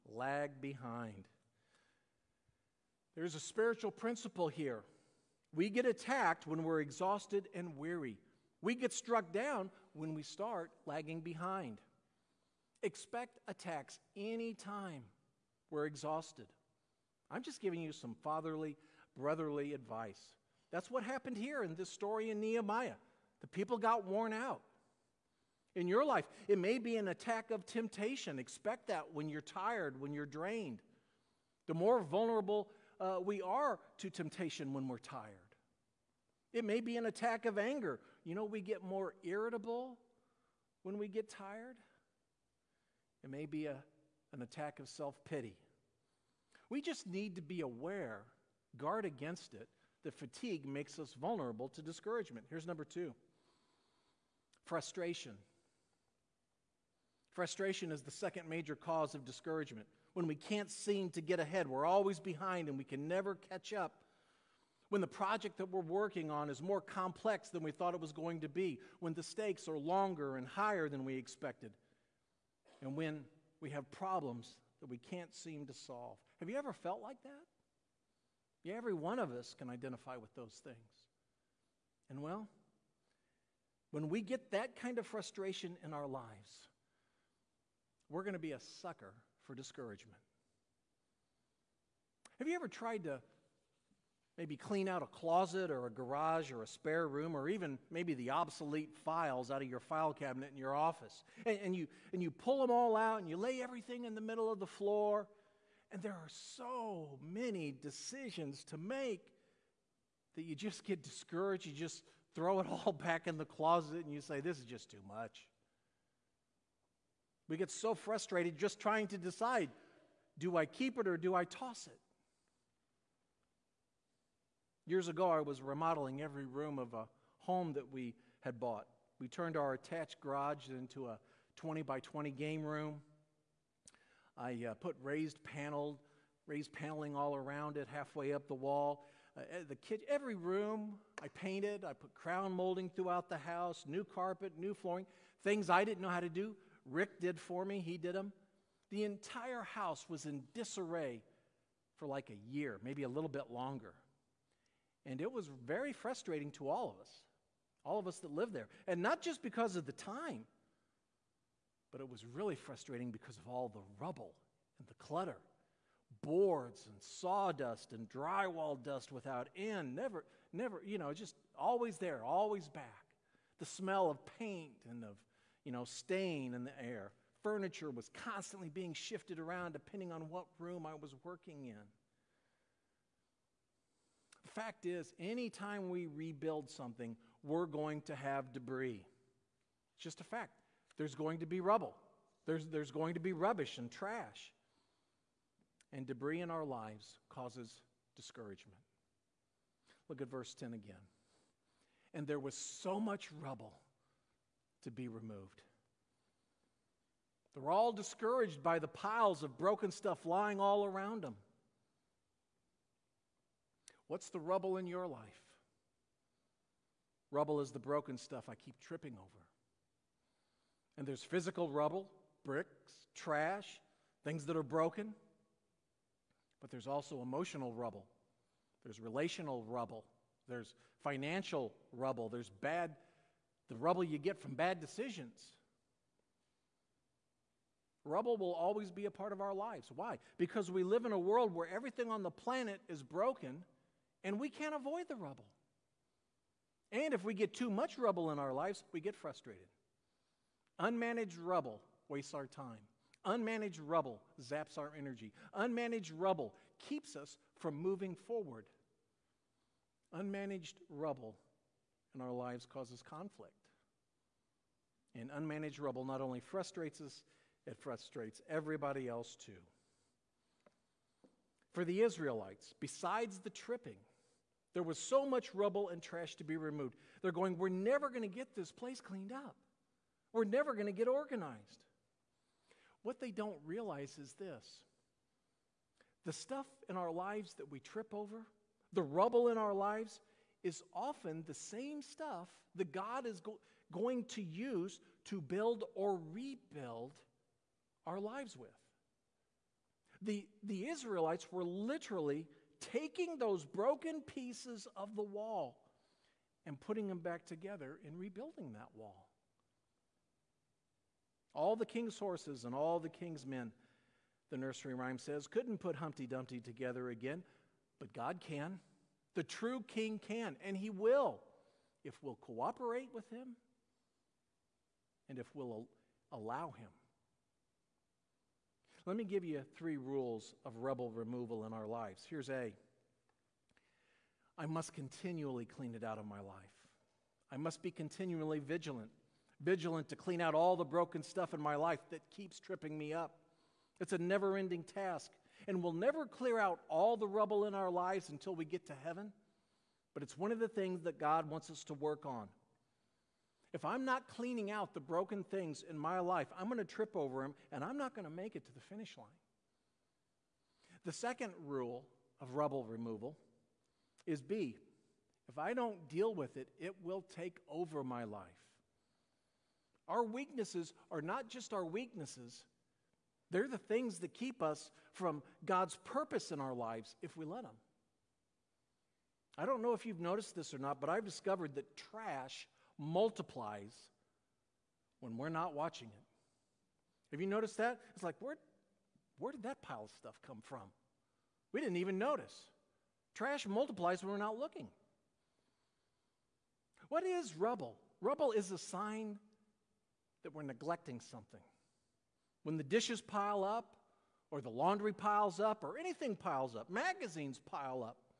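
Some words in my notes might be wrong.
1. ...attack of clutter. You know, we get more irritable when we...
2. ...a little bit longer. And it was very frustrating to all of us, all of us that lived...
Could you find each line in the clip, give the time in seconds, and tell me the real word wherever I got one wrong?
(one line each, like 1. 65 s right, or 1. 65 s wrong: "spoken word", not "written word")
1. 37 s wrong: "anger", not "clutter"
2. 153 s right.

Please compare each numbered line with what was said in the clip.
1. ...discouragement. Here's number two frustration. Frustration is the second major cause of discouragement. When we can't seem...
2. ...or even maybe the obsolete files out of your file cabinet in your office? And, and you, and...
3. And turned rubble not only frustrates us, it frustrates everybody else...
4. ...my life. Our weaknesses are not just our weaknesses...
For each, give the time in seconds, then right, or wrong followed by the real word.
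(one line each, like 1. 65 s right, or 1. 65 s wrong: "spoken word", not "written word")
1. 51 s right
2. 97 s right
3. 265 s wrong: "unmanaged", not "turned"
4. 368 s right.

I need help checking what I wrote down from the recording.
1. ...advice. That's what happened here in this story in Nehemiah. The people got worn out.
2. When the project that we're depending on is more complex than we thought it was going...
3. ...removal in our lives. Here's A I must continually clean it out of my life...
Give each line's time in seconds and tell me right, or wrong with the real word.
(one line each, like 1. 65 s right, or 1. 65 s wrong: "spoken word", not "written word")
1. 19 s right
2. 64 s wrong: "working", not "depending"
3. 331 s right.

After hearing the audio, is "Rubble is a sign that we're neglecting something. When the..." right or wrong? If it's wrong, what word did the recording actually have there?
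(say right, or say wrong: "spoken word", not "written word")
right.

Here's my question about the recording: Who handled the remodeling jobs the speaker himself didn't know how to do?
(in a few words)
Rick.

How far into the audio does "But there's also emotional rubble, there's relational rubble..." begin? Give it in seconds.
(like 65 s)
226 s.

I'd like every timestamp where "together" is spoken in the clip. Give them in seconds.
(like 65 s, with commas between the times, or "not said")
307 s, 316 s.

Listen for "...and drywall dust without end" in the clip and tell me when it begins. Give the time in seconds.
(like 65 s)
167 s.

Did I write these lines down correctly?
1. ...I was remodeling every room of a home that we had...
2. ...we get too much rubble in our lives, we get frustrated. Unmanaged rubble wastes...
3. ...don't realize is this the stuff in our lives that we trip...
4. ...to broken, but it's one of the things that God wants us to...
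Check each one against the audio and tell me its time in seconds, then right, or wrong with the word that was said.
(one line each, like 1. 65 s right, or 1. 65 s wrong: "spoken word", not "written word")
1. 125 s right
2. 247 s right
3. 283 s right
4. 348 s wrong: "heaven", not "broken".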